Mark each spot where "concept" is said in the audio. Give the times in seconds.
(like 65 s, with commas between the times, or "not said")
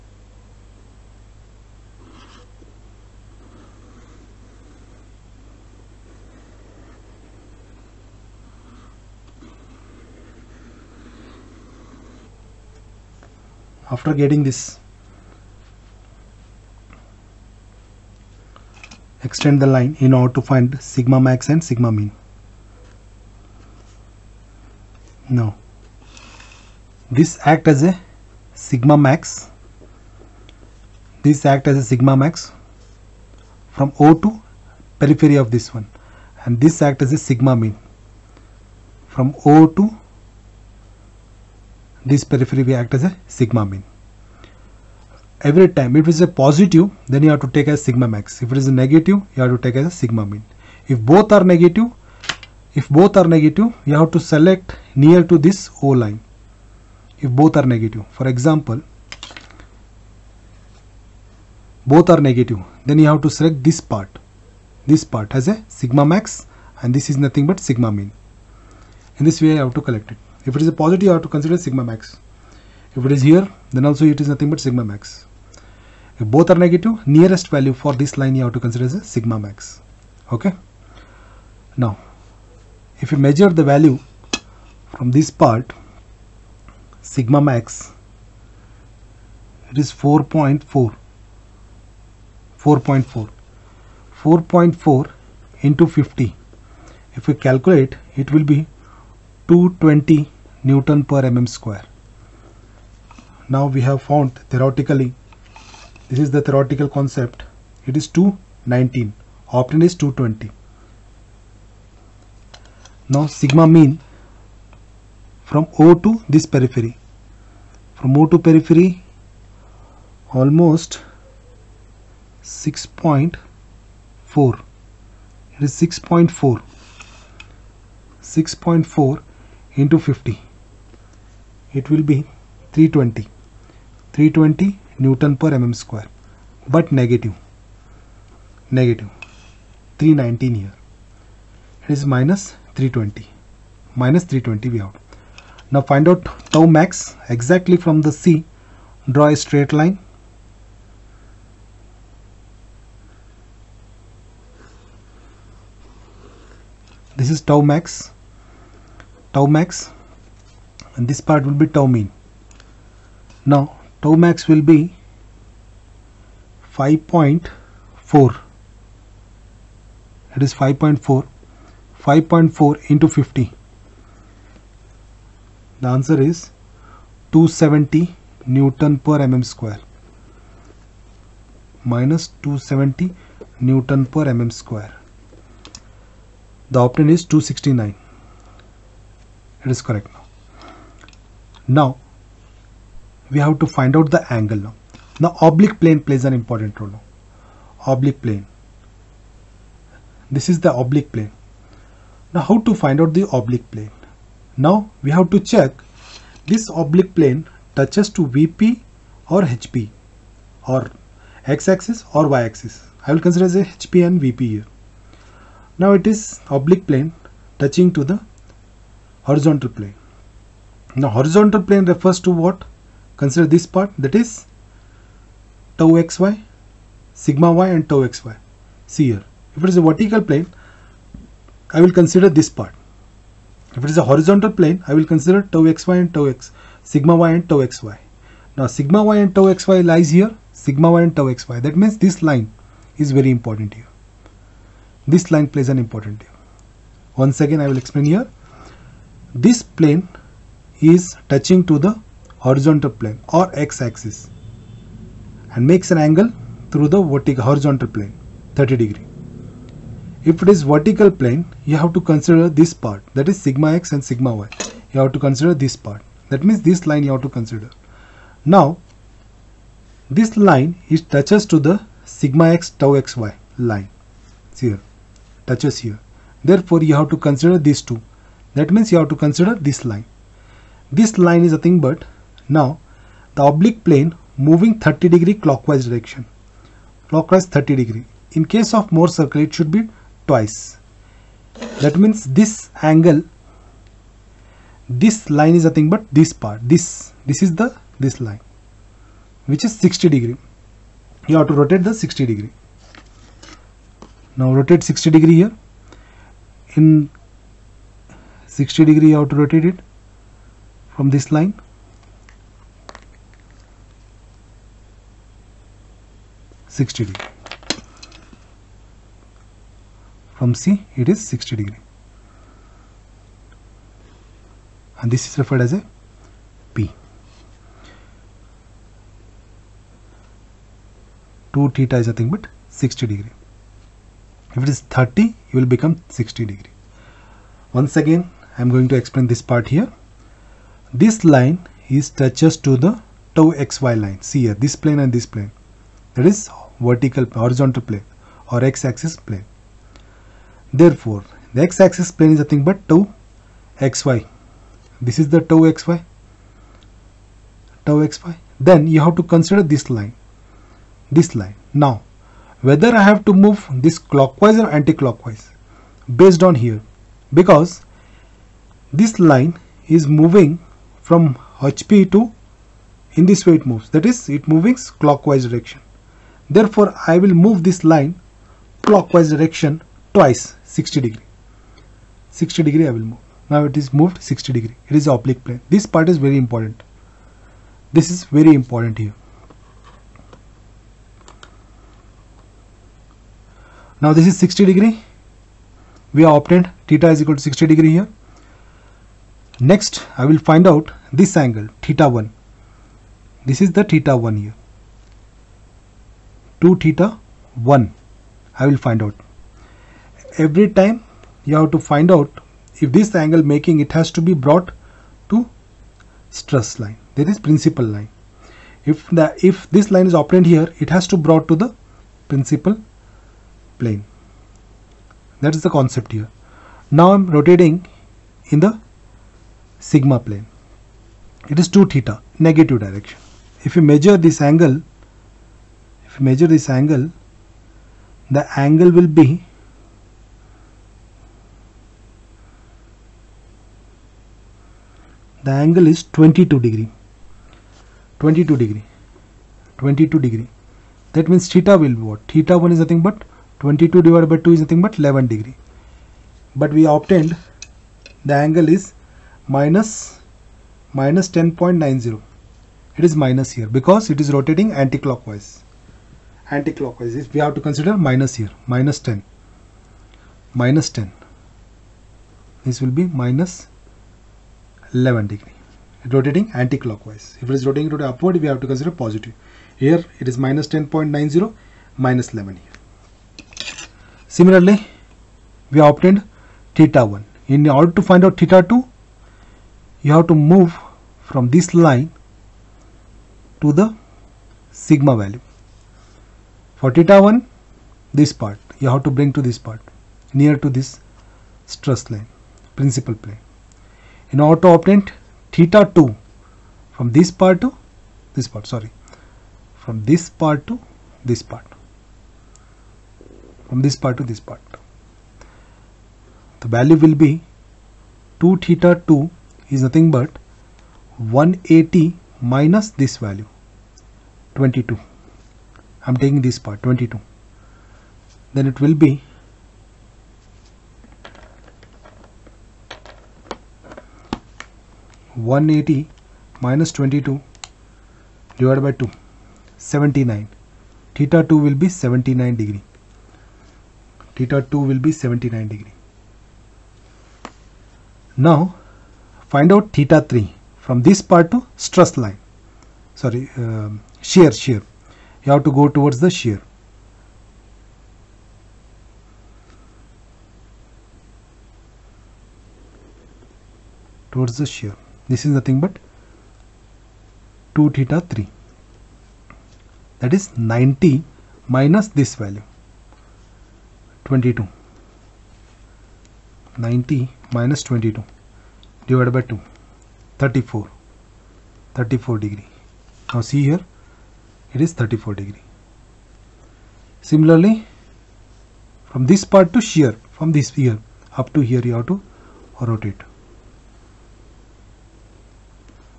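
106 s, 425 s.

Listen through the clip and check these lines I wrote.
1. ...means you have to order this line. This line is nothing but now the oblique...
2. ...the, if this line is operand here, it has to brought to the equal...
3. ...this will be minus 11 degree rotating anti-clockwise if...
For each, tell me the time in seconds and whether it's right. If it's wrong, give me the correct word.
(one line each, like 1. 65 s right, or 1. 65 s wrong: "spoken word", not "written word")
1. 278 s wrong: "consider", not "order"
2. 419 s wrong: "principal", not "equal"
3. 472 s right.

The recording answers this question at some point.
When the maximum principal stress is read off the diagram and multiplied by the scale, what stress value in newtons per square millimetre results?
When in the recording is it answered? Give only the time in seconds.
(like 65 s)
99 s.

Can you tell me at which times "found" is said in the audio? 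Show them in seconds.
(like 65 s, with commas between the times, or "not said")
104 s.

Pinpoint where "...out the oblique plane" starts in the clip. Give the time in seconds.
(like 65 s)
203 s.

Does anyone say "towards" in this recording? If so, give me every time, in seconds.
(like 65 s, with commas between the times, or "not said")
555 s, 564 s.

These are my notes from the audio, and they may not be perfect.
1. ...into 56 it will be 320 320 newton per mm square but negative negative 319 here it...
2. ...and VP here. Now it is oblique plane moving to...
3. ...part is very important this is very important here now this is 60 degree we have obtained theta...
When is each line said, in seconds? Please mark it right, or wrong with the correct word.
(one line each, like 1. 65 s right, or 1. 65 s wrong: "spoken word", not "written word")
1. 129 s wrong: "50", not "56"
2. 214 s wrong: "touching", not "moving"
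3. 385 s right.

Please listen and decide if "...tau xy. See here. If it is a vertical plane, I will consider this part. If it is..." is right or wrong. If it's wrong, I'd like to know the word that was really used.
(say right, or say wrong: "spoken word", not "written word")
right.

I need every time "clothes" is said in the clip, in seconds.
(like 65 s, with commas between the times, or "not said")
not said.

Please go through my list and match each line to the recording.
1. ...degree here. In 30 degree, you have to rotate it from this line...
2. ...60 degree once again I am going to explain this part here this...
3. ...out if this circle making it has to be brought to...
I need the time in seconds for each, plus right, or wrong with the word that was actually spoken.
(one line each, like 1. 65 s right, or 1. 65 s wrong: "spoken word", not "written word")
1. 305 s wrong: "60", not "30"
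2. 336 s right
3. 412 s wrong: "angle", not "circle".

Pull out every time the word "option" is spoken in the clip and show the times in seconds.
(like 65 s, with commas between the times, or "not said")
109 s, 186 s.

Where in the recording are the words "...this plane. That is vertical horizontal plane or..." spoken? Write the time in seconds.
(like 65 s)
345 s.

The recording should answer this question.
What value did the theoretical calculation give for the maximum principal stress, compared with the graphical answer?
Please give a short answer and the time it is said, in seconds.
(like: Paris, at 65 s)
219, at 108 s.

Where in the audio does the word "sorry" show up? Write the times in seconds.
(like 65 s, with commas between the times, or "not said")
508 s, 553 s.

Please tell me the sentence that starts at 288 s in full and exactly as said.
In case of Mohr circle, it should be twice.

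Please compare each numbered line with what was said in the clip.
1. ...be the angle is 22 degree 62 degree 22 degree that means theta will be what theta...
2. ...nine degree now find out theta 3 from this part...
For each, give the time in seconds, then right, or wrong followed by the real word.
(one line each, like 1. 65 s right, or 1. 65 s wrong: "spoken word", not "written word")
1. 439 s wrong: "22", not "62"
2. 545 s right.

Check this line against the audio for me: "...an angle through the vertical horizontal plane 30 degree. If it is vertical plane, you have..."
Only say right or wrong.
right.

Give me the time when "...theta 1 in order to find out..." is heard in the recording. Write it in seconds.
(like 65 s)
486 s.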